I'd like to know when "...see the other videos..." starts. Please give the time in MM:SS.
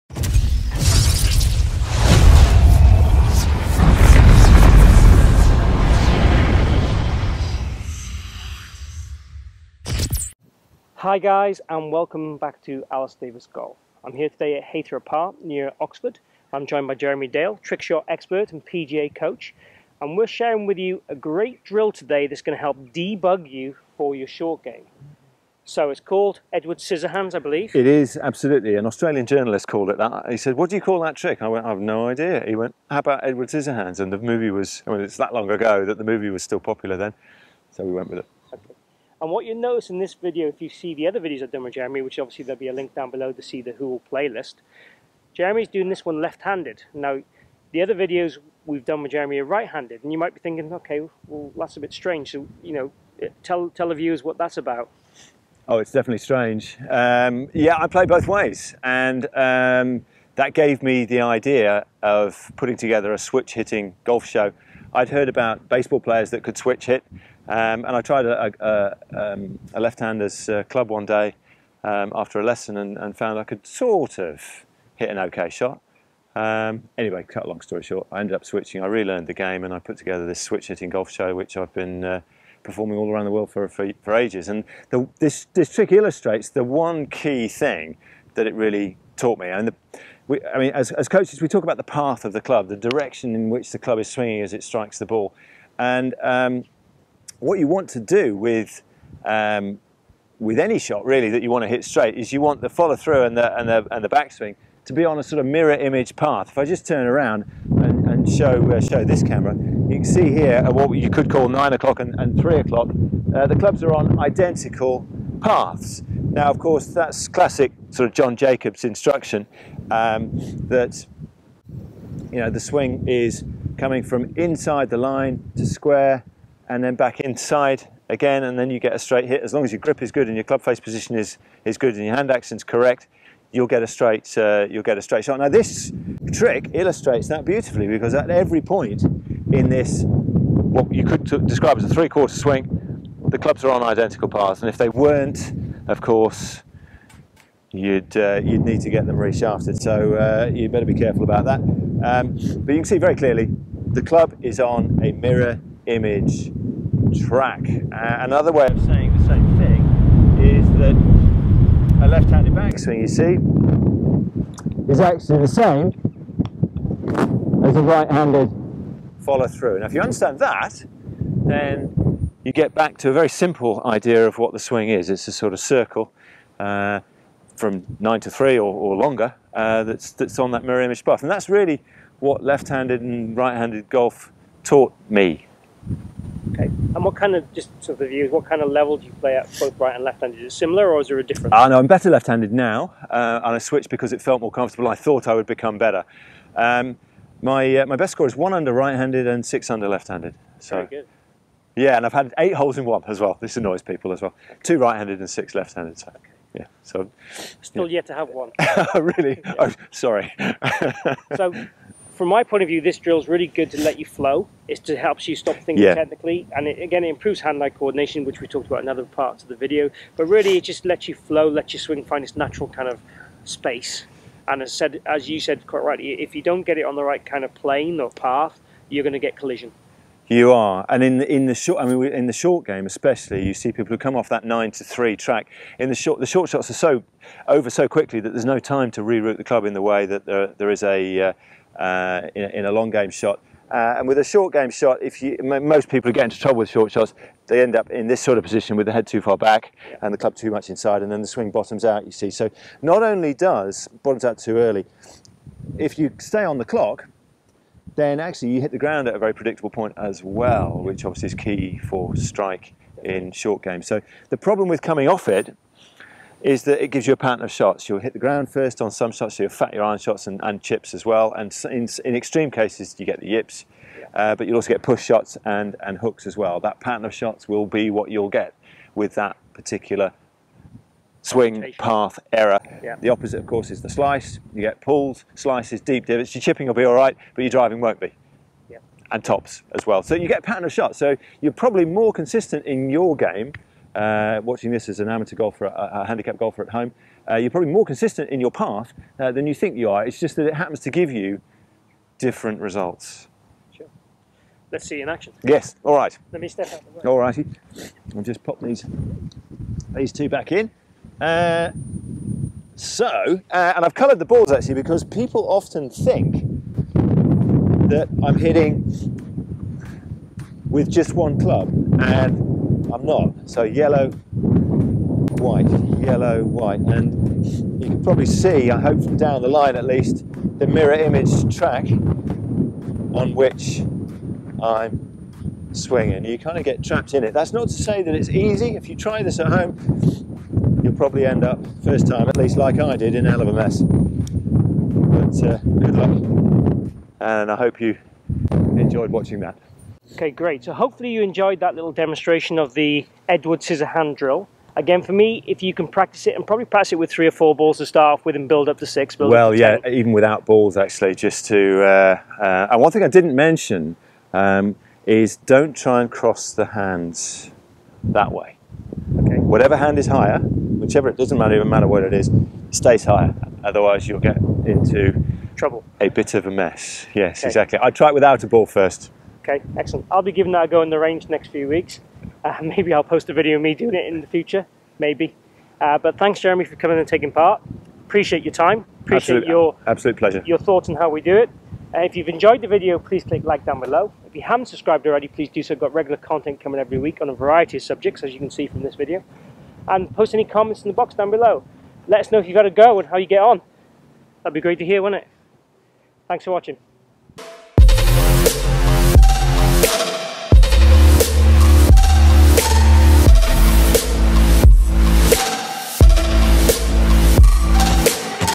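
00:40.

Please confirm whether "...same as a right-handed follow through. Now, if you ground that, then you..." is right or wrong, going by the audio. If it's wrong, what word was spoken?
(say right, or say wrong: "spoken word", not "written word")
wrong: "understand", not "ground".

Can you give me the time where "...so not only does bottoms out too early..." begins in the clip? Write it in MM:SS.
04:12.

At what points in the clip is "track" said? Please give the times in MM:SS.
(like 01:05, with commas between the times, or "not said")
02:37, 03:55, 05:31.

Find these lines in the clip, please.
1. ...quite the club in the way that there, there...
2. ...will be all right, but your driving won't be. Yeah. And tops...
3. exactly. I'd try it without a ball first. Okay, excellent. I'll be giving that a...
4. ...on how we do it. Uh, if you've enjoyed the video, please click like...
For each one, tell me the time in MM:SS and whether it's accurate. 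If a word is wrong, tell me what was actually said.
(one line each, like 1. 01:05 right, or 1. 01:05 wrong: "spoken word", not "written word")
1. 03:59 wrong: "reroute", not "quite"
2. 04:46 right
3. 06:17 right
4. 06:30 right.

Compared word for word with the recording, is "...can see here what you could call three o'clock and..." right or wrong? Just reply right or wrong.
wrong.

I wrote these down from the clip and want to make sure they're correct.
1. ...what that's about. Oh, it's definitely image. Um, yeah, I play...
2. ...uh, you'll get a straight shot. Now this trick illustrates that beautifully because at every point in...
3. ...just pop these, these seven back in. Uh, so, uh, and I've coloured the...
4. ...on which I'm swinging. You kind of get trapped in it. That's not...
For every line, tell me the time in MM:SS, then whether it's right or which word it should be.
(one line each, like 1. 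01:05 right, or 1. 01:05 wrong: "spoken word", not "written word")
1. 00:54 wrong: "strange", not "image"
2. 02:14 right
3. 05:08 wrong: "two", not "seven"
4. 05:31 right.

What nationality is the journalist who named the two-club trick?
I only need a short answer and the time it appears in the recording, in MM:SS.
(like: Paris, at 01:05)
Australian, at 00:28.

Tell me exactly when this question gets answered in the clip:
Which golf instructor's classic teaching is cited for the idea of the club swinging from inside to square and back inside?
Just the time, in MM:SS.
01:58.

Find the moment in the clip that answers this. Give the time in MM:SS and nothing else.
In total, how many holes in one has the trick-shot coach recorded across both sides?
03:22.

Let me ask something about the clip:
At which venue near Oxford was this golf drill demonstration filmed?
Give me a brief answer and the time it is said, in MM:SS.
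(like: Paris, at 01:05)
Heythrop Park, at 00:14.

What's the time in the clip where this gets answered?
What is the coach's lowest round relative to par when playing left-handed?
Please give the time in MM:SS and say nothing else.
03:19.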